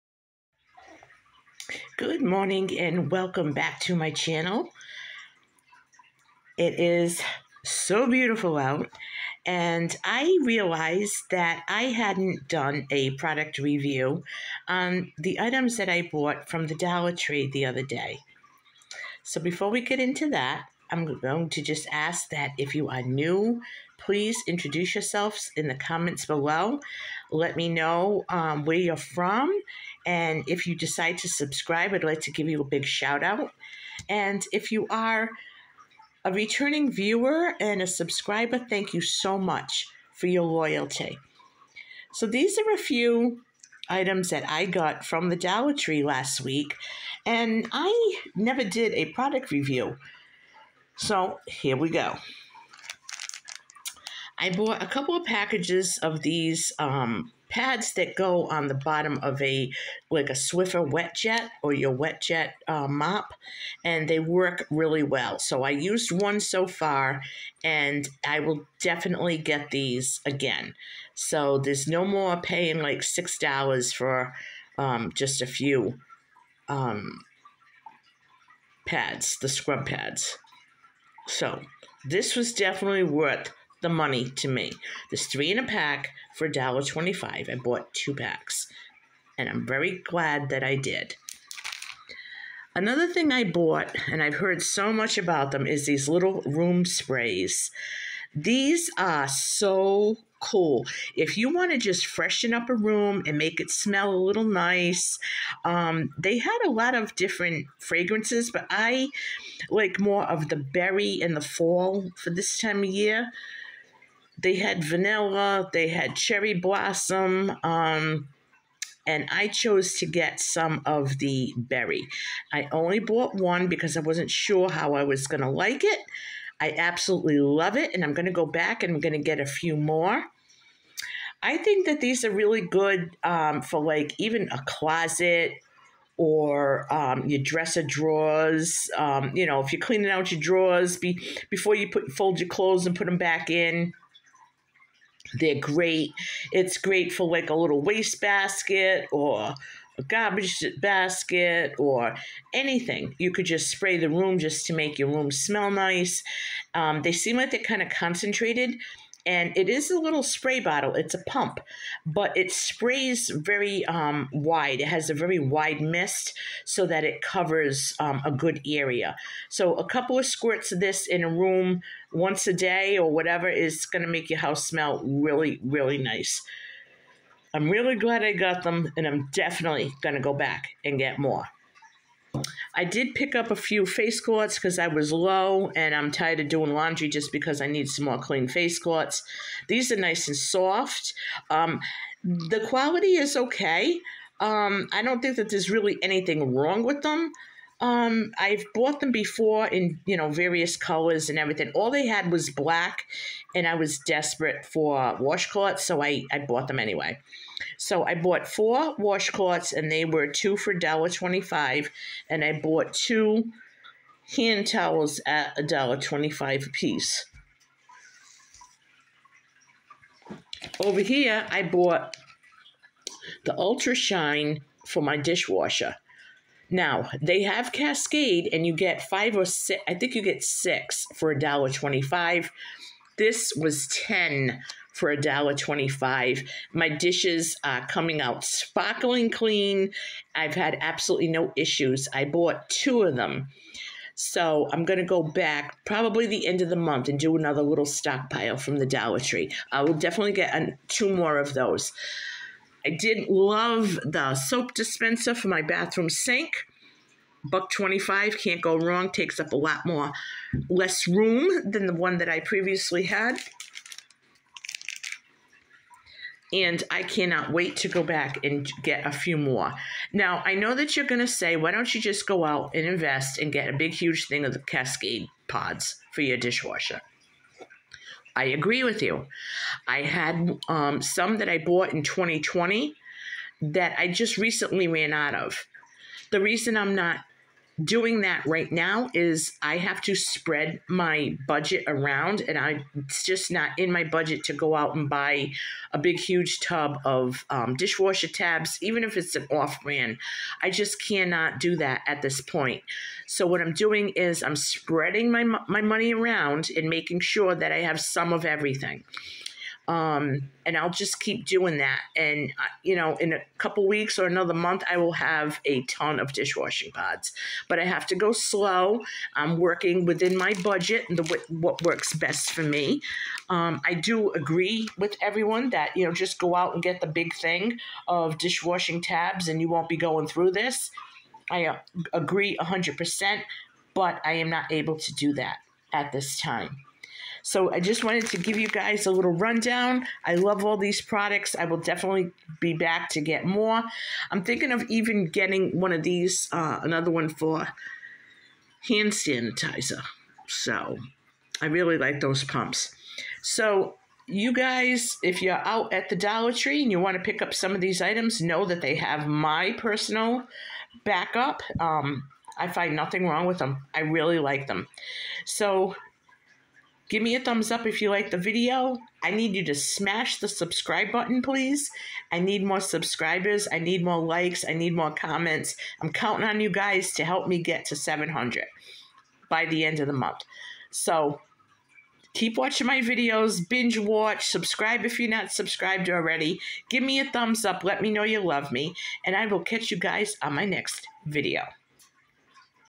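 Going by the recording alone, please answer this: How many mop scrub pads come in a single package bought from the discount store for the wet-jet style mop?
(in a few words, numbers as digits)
3.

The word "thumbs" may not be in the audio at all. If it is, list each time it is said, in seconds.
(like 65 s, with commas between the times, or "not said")
367 s, 387 s.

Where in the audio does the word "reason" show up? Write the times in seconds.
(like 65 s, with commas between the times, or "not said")
286 s.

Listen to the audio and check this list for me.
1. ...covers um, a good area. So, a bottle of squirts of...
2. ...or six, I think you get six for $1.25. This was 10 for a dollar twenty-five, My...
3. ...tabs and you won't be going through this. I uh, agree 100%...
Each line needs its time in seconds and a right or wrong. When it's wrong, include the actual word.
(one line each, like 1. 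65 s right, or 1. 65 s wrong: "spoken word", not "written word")
1. 167 s wrong: "couple", not "bottle"
2. 229 s right
3. 329 s right.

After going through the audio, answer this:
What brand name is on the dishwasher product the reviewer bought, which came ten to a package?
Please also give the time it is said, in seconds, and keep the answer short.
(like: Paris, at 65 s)
Ultra Shine, at 223 s.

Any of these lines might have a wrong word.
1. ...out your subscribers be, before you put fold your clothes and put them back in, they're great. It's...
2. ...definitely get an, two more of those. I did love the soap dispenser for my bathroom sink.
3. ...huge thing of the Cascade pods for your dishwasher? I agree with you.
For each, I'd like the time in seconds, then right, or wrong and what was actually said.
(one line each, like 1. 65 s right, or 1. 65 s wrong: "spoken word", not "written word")
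1. 140 s wrong: "drawers", not "subscribers"
2. 249 s right
3. 273 s right.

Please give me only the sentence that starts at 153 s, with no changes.
You could just spray the room just to make your room smell nice.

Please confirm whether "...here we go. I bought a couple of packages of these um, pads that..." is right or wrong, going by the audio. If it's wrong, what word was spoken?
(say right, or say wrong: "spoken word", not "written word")
right.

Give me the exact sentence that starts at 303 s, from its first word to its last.
So what I'm doing is I'm spreading my my money around and making sure that I have some of everything.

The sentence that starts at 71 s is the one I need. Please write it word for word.
So there's no more paying like six dollars for um, just a few um, pads, the scrub pads.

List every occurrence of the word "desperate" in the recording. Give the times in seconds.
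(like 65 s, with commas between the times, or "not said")
203 s.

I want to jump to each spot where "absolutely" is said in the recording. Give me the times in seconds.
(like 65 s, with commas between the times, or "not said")
126 s, 240 s.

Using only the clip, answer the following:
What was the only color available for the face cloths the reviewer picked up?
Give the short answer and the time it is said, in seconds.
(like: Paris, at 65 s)
black, at 202 s.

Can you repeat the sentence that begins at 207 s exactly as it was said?
So I bought four washcloths and they were two for $1.25 and I bought two hand towels at $1.25 a piece.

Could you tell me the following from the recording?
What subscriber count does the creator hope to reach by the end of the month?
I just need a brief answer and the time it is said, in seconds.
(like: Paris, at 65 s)
700, at 377 s.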